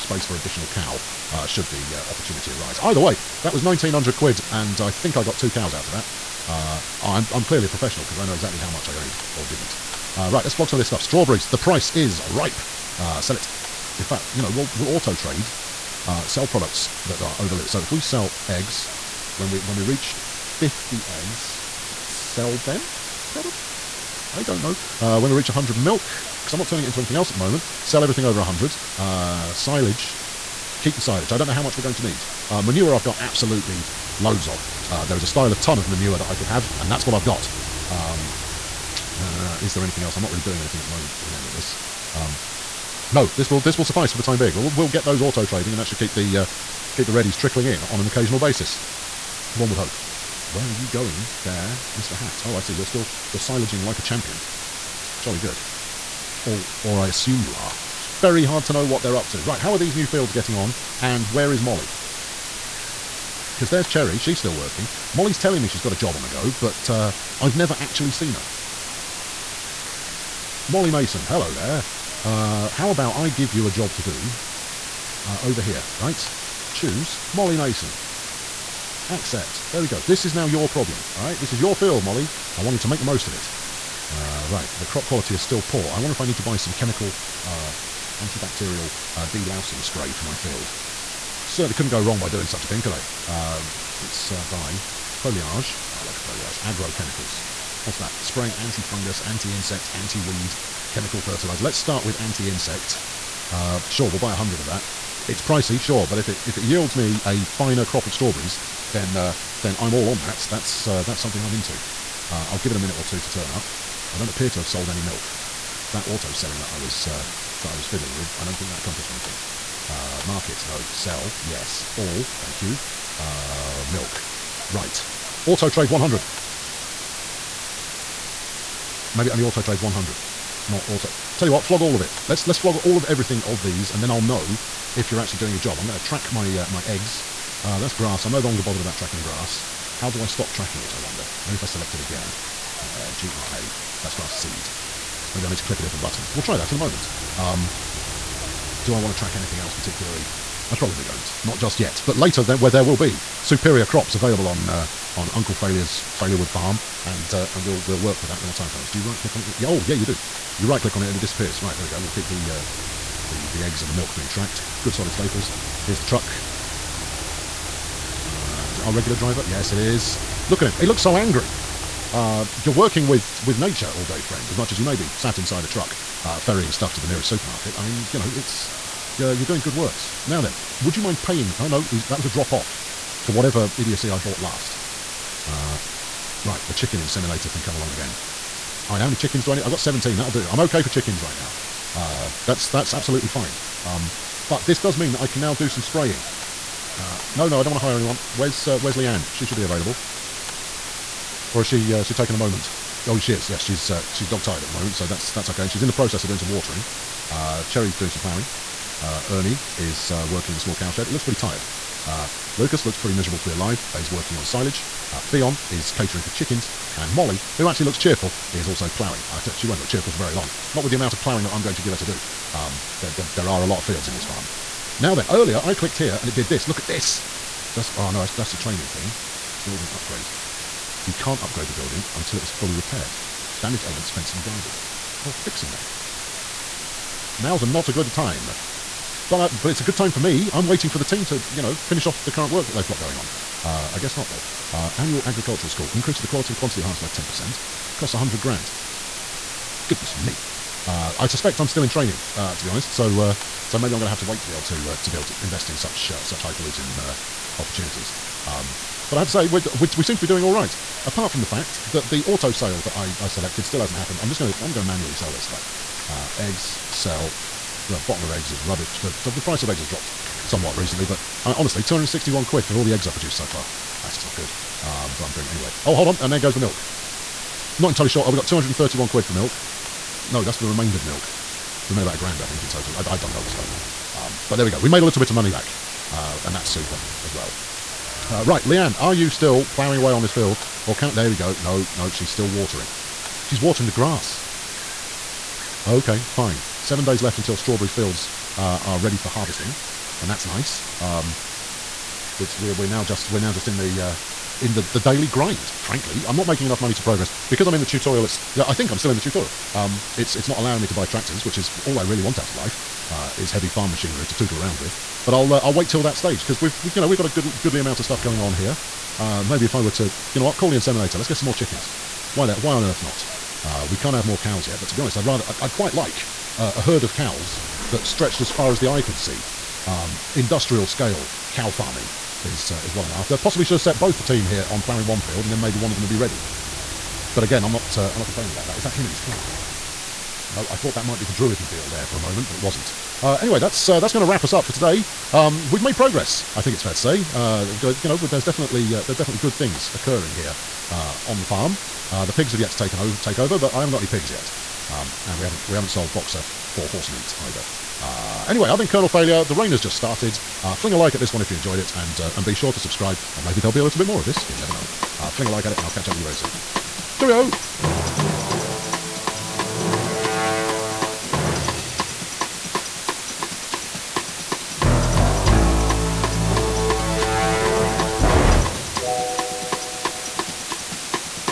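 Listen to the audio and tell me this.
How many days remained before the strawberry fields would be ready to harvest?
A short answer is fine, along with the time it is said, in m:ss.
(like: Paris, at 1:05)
7, at 4:56.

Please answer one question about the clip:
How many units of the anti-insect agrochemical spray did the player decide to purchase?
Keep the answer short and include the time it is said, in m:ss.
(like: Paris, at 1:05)
100, at 1:44.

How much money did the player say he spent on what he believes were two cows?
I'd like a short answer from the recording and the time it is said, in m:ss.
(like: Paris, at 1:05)
1,900 quid, at 0:03.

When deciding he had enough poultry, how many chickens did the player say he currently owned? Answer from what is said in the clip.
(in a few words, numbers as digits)
17.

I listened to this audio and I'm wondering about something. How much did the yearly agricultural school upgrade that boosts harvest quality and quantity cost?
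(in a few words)
100 grand.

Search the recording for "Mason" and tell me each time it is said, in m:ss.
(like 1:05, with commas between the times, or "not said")
1:10, 1:17.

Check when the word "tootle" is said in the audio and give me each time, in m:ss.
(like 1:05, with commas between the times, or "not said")
5:14.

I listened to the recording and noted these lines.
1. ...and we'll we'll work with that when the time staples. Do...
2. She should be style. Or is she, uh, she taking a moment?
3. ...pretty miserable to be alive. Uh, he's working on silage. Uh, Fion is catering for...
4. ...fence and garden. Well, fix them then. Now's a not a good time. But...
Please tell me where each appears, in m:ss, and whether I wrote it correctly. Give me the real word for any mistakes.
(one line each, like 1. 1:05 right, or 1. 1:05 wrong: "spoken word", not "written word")
1. 2:37 wrong: "comes", not "staples"
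2. 3:19 wrong: "available", not "style"
3. 3:32 right
4. 3:54 right.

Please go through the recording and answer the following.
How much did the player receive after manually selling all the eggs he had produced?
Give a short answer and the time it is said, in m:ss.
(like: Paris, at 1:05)
261 quid, at 4:31.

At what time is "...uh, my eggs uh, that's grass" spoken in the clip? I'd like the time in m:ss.
2:16.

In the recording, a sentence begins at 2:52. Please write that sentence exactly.
Uh, you're working with with nature all day, friend.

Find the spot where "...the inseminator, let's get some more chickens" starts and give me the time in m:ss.
5:20.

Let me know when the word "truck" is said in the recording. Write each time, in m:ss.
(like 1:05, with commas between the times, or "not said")
2:46, 2:55.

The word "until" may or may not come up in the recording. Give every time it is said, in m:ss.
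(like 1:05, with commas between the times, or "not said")
3:52, 4:57.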